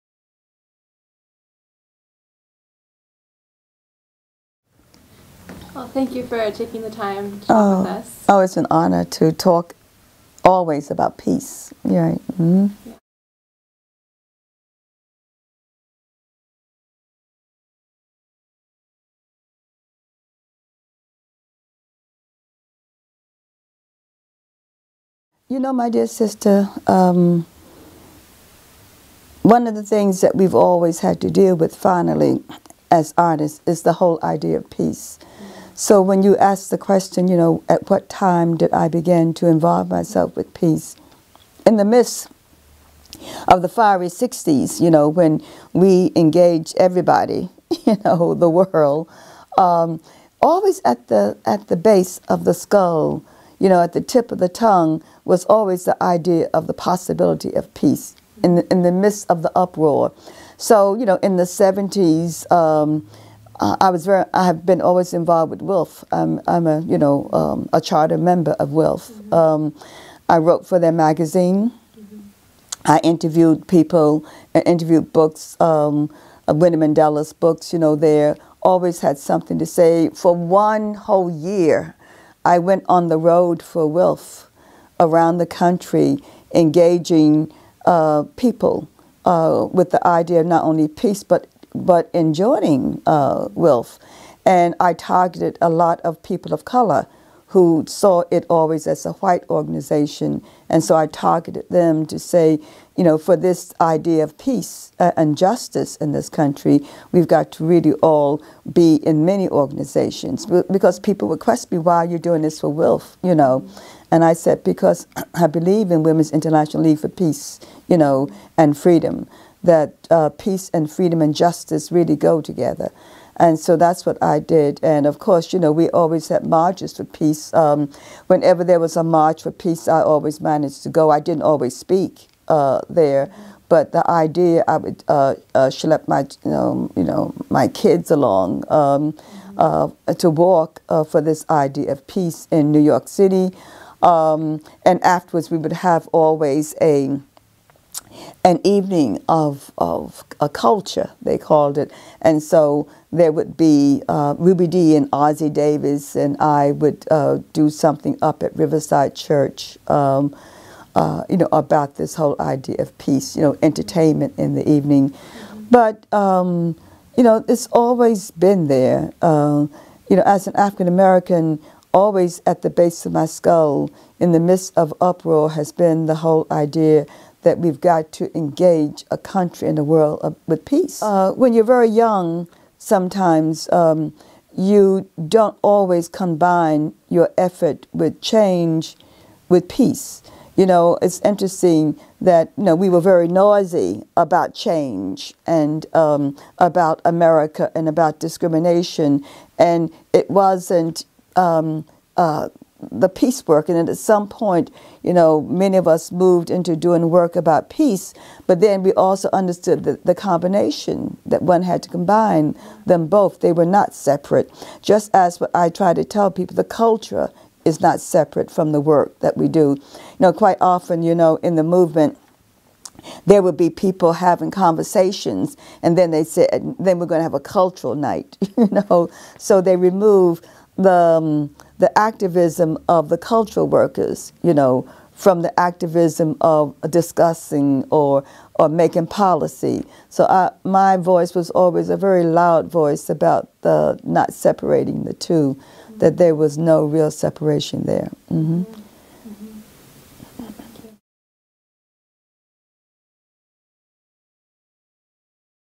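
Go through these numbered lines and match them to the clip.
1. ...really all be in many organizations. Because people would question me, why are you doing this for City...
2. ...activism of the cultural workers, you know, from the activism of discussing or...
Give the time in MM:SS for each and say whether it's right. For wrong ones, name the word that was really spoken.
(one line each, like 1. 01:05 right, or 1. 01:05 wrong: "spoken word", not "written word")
1. 01:47 wrong: "WILF", not "City"
2. 03:51 right.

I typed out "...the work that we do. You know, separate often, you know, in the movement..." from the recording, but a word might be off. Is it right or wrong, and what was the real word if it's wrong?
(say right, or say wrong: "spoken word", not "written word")
wrong: "quite", not "separate".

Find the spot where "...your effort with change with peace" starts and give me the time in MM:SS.
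03:07.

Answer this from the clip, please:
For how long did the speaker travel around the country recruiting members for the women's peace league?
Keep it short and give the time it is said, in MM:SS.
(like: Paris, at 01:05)
1 year, at 01:20.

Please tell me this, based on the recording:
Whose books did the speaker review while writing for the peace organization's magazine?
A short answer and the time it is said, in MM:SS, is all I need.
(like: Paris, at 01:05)
Winnie Mandela, at 01:16.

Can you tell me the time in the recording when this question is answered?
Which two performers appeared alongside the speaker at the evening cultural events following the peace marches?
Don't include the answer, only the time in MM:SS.
02:34.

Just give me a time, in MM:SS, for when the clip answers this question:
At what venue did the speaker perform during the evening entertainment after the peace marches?
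02:38.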